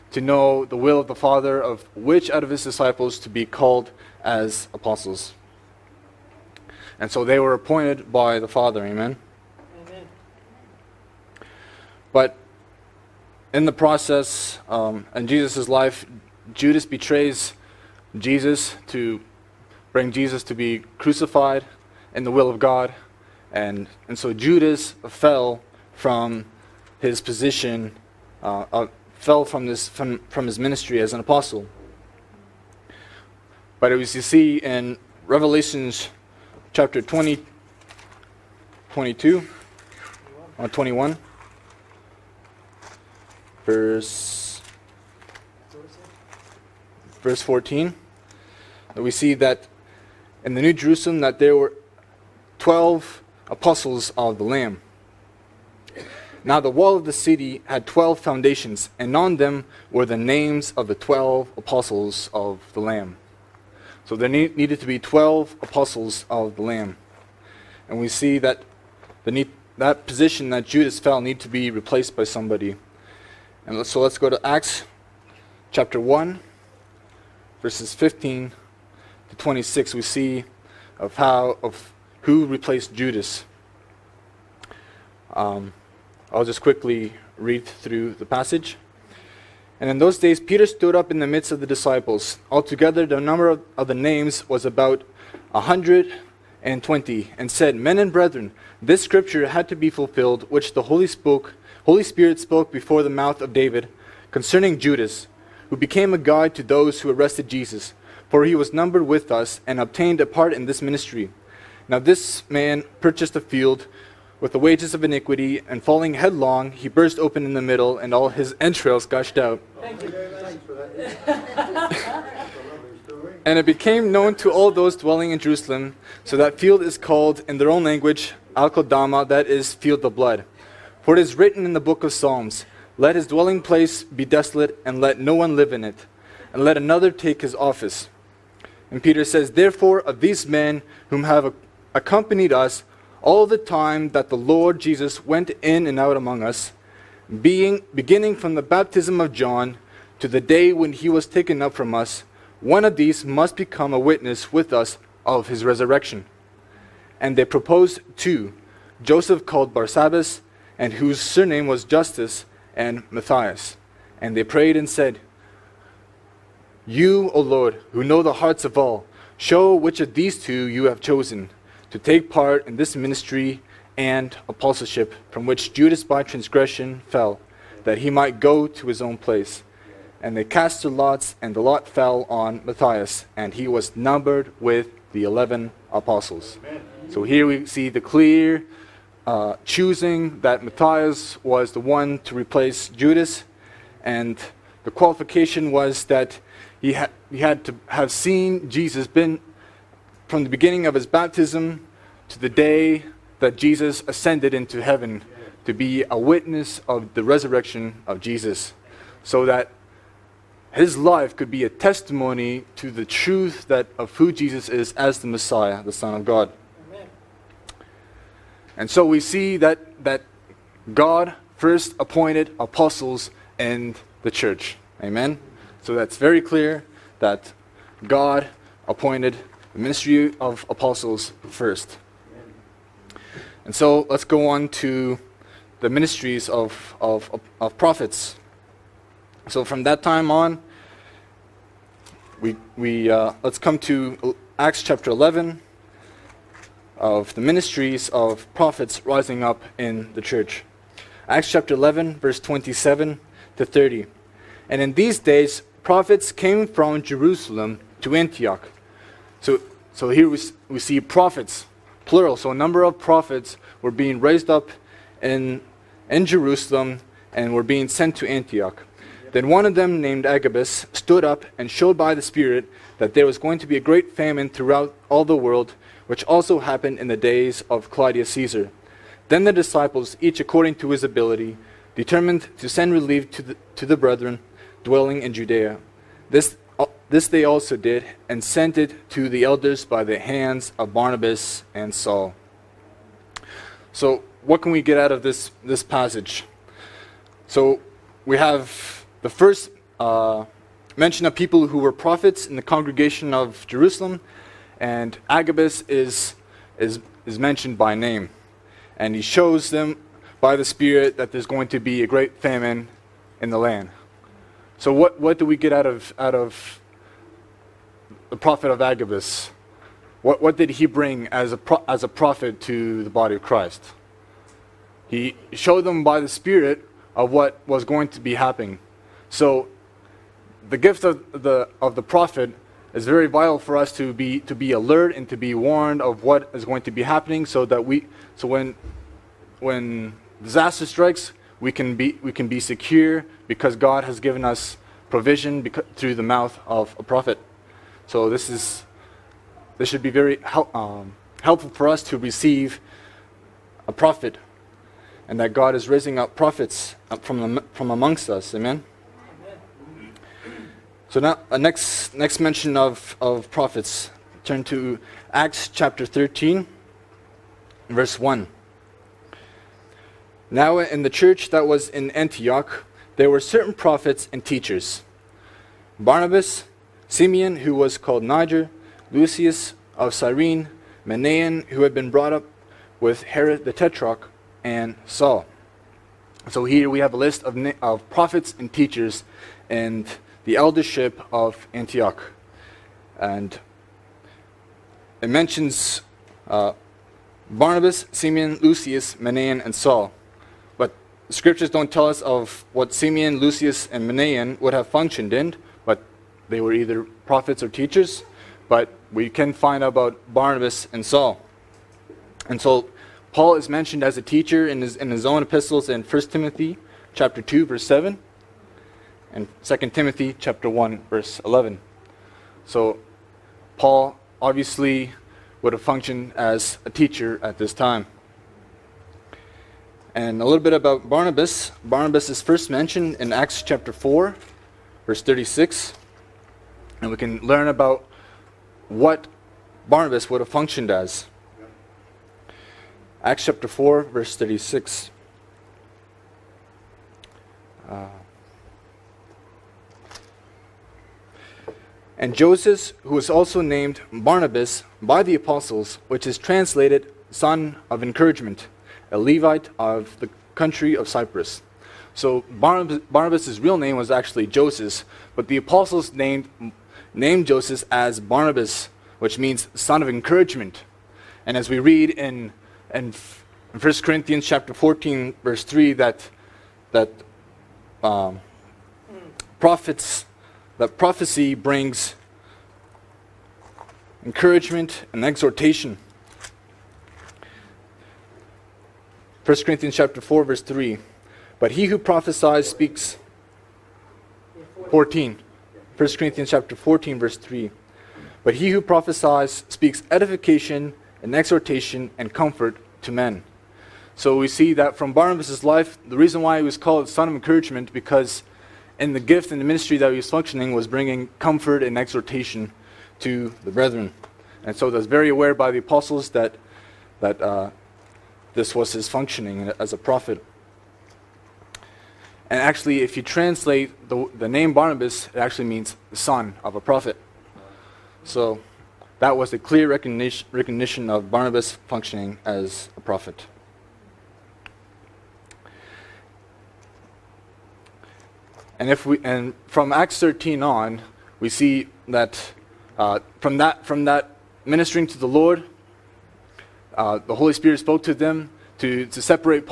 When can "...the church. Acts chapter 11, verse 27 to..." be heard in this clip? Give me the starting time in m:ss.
4:10.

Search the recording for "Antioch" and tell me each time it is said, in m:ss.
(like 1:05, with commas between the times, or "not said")
4:18, 4:28, 6:12, 6:31.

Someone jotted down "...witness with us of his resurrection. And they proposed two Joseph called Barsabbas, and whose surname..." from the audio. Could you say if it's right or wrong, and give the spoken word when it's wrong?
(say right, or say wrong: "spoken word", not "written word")
right.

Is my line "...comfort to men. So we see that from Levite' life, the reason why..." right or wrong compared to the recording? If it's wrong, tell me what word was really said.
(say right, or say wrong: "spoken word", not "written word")
wrong: "Barnabas", not "Levite".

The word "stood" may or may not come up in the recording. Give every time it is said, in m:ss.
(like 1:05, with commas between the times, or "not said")
1:30, 4:30.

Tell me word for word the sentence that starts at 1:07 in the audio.
And we see that the that position that Judas fell need to be replaced by somebody.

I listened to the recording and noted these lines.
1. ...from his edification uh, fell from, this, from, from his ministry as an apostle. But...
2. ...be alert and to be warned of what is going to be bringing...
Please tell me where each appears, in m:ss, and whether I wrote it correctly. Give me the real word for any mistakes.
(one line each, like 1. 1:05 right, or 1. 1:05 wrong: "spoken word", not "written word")
1. 0:25 wrong: "position", not "edification"
2. 5:34 wrong: "happening", not "bringing".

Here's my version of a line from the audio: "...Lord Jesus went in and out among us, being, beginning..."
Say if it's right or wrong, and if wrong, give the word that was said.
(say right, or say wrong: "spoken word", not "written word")
right.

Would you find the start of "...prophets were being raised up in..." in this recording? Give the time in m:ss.
4:22.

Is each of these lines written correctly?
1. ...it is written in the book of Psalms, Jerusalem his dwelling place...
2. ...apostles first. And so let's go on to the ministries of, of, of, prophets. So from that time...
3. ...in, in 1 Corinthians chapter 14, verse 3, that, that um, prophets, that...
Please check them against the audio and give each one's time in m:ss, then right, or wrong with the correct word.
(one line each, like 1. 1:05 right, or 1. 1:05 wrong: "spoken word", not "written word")
1. 2:11 wrong: "Let", not "Jerusalem"
2. 3:50 right
3. 7:52 right.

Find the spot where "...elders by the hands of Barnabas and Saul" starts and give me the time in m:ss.
4:49.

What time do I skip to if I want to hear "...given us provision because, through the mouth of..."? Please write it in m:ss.
5:44.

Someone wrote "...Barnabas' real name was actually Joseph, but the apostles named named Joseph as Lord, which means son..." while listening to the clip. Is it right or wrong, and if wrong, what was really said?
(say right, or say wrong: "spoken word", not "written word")
wrong: "Barnabas", not "Lord".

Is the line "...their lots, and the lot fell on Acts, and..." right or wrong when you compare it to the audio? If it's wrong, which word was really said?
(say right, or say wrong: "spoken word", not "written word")
wrong: "Matthias", not "Acts".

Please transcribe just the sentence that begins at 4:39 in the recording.
Then the disciples, each according to his ability, determined to send relief to the, to the brethren dwelling in Judea.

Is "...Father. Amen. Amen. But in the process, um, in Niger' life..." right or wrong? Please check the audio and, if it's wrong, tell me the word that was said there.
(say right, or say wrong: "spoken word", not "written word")
wrong: "Jesus", not "Niger".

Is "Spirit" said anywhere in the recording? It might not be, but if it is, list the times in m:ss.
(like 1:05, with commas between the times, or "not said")
1:42, 4:32, 5:10, 5:26, 9:07.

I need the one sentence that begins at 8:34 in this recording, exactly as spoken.
And so that's very aware by the apostles that, that uh, this was his functioning as a prophet.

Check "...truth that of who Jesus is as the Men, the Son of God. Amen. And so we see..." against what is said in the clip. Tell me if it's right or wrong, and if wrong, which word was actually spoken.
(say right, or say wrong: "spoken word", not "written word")
wrong: "Messiah", not "Men".